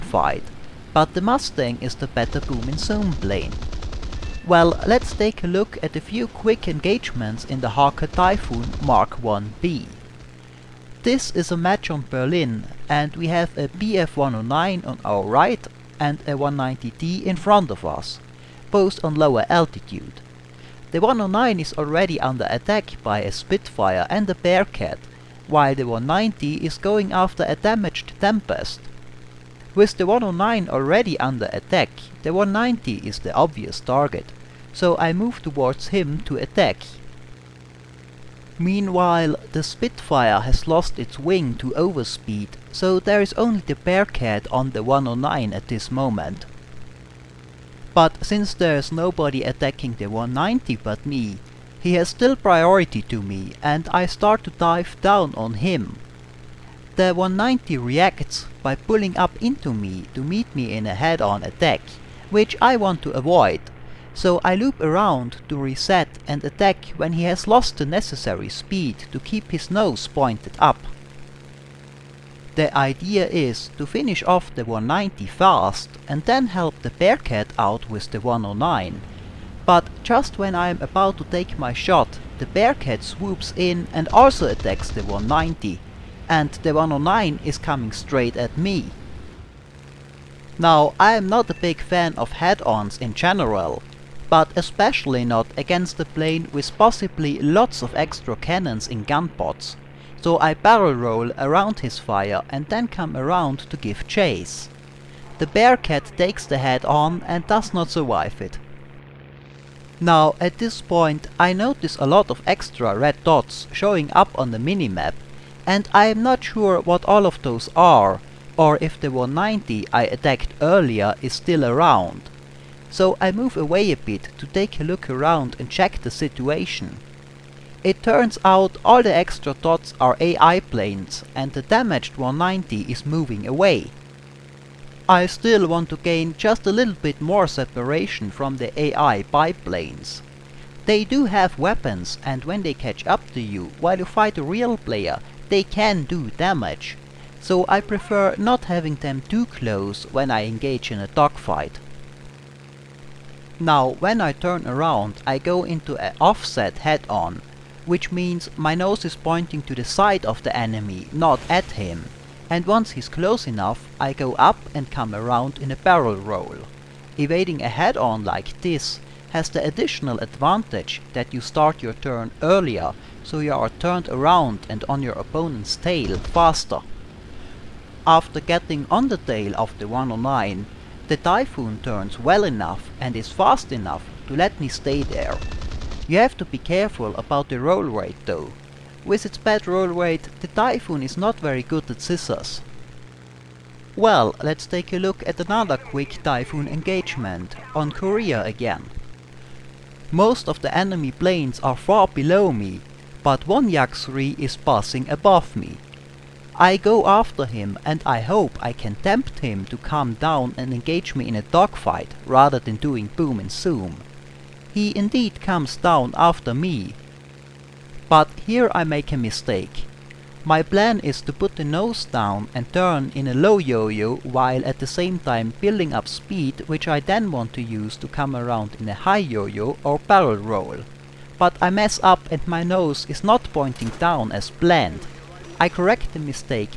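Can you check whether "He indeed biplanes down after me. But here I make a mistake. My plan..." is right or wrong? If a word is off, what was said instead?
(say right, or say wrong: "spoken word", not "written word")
wrong: "comes", not "biplanes".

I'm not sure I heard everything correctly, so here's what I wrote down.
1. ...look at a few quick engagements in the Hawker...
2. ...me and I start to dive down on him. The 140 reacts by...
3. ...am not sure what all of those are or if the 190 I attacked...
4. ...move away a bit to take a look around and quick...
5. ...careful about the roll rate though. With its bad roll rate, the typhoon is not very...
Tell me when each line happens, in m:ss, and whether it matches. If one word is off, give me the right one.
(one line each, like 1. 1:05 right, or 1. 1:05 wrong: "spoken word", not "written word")
1. 0:05 right
2. 0:53 wrong: "190", not "140"
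3. 1:56 right
4. 2:03 wrong: "check", not "quick"
5. 3:06 right.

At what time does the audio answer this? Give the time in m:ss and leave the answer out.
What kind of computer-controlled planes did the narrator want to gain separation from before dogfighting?
2:18.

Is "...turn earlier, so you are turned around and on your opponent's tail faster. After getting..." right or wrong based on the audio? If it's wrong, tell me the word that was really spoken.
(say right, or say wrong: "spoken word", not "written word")
right.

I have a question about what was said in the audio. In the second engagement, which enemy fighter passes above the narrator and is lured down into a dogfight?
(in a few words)
Yak-3.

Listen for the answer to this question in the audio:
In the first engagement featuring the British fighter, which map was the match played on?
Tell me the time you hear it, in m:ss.
0:12.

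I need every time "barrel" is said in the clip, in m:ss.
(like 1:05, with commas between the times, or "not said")
1:40, 2:45, 3:49.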